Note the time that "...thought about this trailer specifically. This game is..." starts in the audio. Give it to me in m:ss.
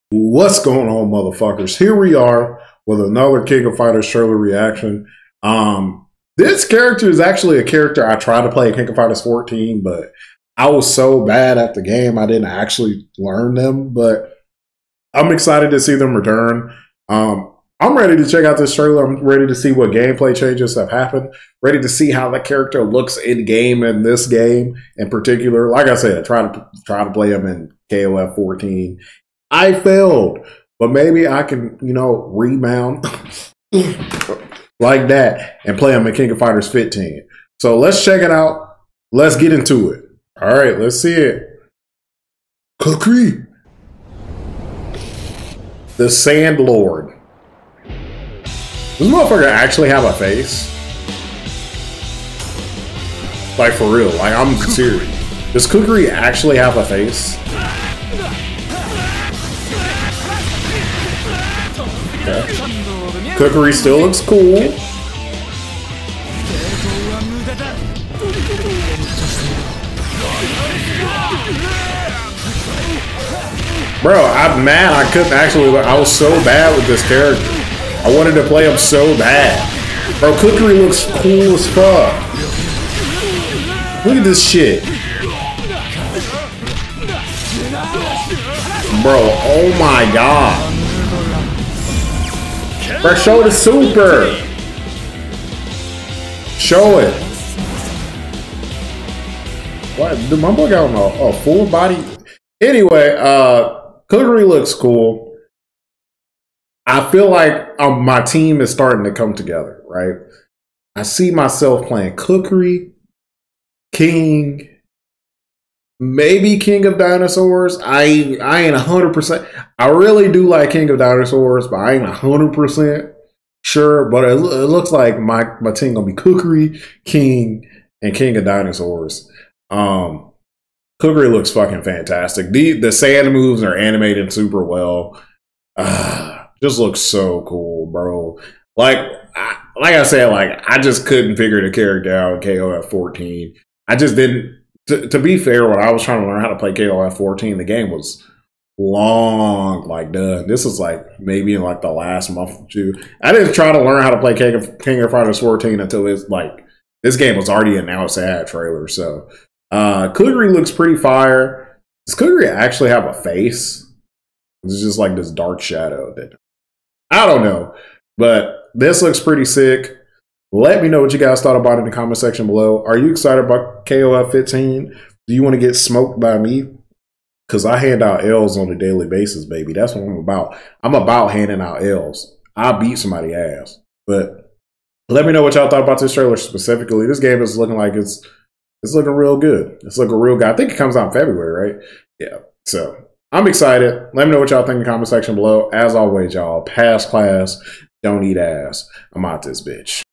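3:05.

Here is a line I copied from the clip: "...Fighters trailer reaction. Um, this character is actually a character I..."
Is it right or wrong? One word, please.
right.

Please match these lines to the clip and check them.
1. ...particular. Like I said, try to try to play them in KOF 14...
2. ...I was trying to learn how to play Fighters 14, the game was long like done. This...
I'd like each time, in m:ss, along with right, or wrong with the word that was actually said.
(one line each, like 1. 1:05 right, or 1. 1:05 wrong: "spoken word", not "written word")
1. 0:25 right
2. 2:25 wrong: "KOF", not "Fighters".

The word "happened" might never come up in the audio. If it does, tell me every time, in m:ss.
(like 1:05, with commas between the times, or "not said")
0:20.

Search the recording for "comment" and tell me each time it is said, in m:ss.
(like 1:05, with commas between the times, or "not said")
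2:51, 3:14.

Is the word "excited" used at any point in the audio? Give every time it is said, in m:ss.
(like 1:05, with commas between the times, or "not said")
0:15, 2:53, 3:13.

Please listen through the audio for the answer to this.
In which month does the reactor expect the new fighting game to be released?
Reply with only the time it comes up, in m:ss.
3:11.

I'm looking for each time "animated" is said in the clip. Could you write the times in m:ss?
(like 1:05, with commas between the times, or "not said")
2:13.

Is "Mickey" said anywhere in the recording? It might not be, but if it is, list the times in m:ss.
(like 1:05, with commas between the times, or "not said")
not said.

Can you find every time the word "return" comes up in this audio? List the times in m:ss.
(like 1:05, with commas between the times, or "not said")
0:16.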